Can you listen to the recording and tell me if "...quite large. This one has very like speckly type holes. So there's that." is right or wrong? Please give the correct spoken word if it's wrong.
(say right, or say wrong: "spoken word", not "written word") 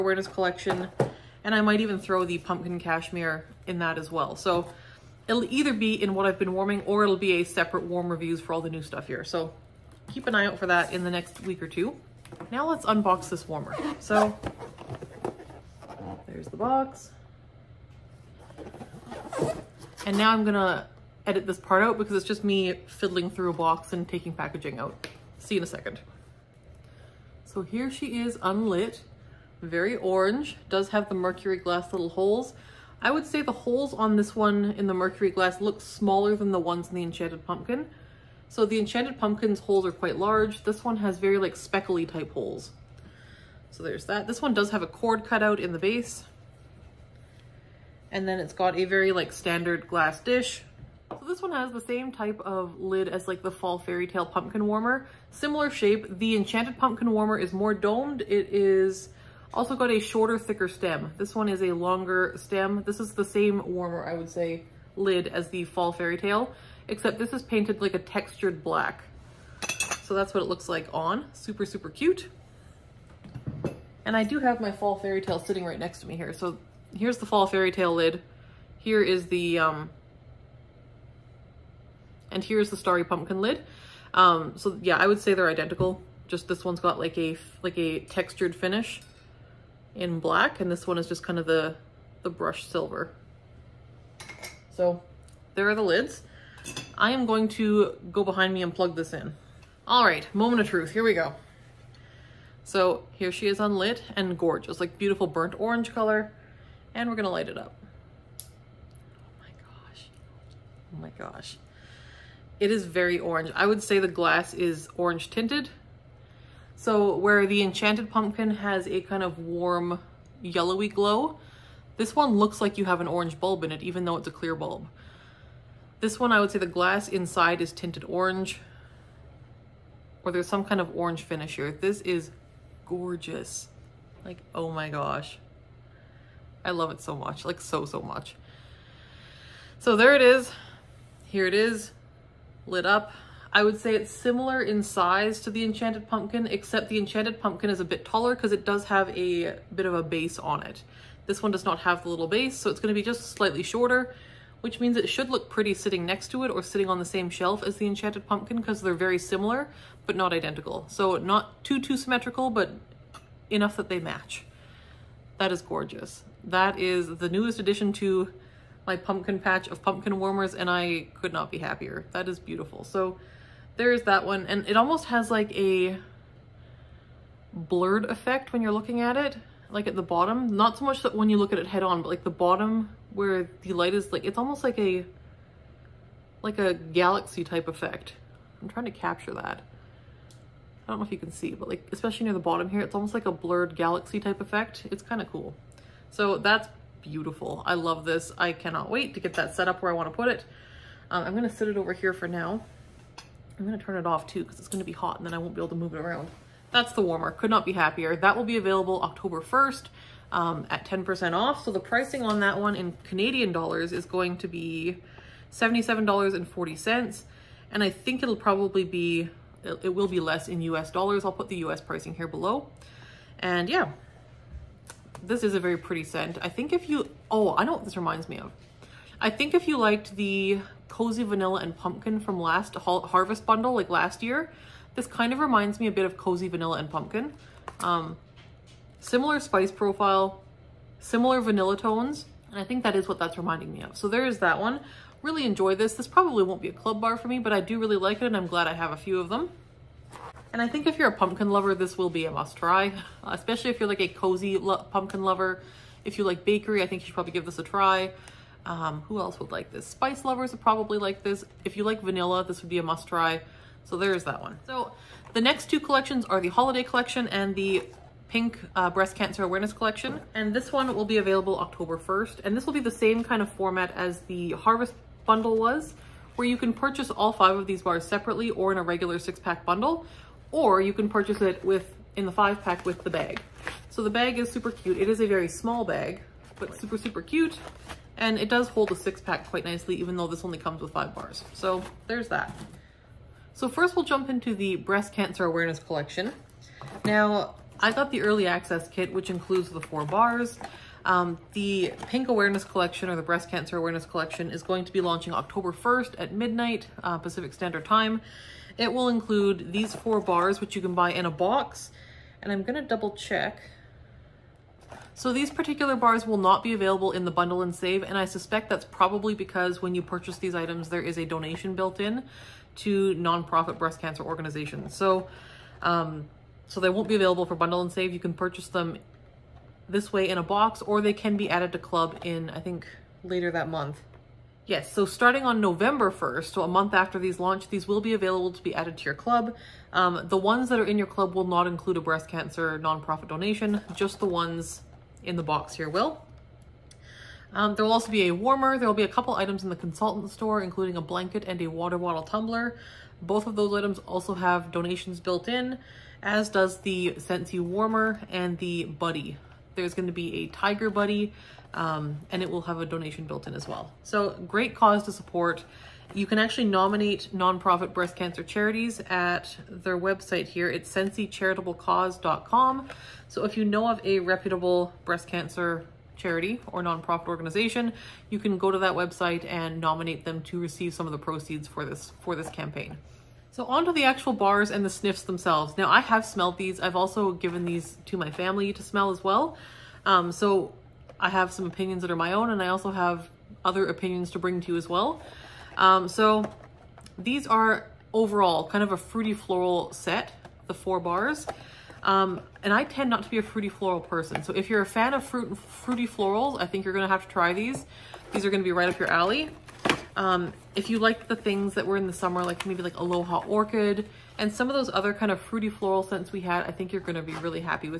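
right.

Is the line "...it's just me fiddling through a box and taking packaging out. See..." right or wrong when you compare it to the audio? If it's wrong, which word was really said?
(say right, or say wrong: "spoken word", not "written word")
right.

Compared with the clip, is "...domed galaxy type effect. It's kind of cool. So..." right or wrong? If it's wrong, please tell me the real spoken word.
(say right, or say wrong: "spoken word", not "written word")
wrong: "blurred", not "domed".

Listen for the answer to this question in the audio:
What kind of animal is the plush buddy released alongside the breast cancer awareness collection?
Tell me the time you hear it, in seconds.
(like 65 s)
360 s.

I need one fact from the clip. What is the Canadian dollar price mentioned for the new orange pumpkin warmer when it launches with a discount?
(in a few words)
$77.40.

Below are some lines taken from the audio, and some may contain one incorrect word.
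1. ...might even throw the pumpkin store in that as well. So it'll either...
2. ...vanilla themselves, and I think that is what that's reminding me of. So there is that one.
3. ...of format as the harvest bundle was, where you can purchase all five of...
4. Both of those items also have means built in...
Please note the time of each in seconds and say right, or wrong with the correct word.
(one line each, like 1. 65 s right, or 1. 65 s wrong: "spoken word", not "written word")
1. 1 s wrong: "cashmere", not "store"
2. 241 s wrong: "tones", not "themselves"
3. 273 s right
4. 353 s wrong: "donations", not "means".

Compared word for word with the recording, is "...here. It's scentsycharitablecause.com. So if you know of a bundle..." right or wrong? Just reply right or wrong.
wrong.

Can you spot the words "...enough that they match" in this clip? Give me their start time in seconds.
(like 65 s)
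163 s.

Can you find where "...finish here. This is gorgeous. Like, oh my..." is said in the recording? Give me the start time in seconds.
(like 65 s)
131 s.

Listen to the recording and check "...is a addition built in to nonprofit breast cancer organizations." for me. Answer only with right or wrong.
wrong.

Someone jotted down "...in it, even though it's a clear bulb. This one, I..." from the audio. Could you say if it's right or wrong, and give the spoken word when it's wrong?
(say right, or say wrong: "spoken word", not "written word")
right.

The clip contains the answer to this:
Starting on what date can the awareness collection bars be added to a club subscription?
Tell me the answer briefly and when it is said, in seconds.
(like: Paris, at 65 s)
November 1st, at 335 s.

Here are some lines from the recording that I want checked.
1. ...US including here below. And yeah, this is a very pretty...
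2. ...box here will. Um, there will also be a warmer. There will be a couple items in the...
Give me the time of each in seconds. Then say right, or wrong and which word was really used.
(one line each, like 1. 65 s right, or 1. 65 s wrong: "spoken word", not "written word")
1. 221 s wrong: "pricing", not "including"
2. 345 s right.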